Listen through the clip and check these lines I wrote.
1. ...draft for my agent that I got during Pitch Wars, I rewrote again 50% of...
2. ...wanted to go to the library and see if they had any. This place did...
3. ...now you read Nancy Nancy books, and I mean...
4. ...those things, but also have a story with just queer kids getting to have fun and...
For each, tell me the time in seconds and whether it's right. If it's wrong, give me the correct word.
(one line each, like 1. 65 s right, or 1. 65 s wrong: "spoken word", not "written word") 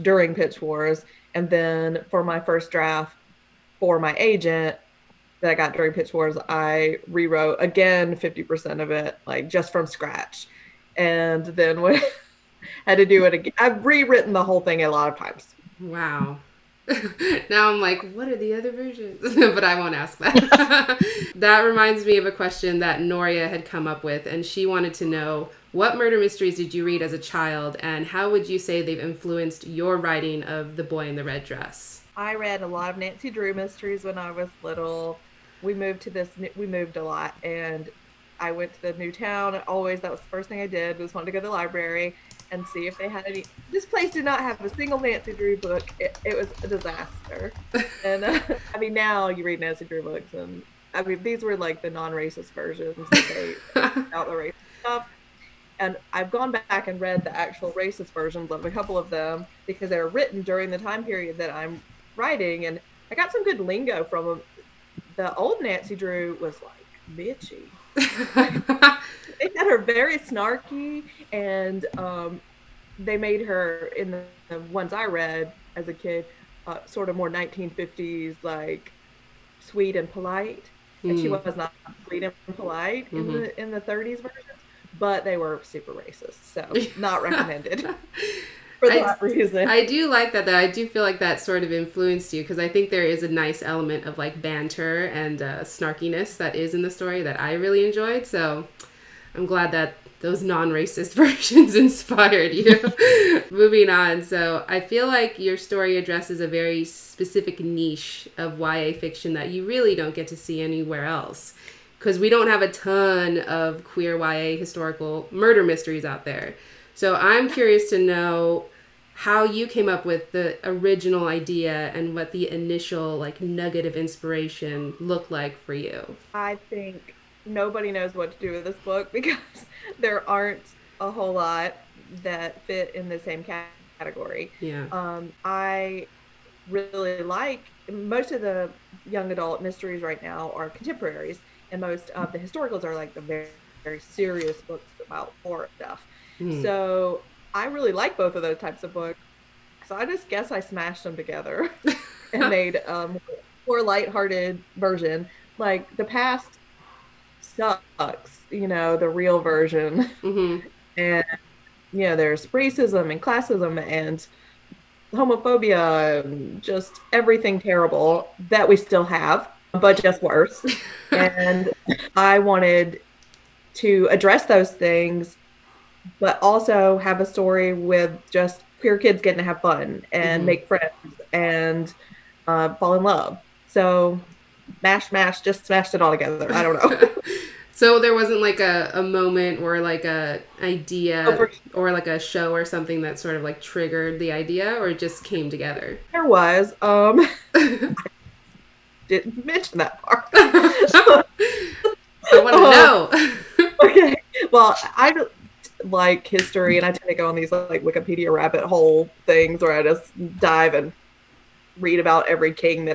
1. 2 s right
2. 41 s right
3. 48 s wrong: "Drew", not "Nancy"
4. 174 s right.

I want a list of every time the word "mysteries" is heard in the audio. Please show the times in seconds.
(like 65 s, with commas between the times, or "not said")
26 s, 33 s, 115 s, 139 s.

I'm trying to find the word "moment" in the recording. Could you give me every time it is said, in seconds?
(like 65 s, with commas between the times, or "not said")
189 s.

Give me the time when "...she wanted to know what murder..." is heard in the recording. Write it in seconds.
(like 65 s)
24 s.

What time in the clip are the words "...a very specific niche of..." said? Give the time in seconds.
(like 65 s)
106 s.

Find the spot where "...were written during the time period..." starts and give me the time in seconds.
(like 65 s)
59 s.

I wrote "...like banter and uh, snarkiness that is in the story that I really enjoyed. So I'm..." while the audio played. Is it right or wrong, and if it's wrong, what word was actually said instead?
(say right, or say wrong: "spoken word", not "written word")
right.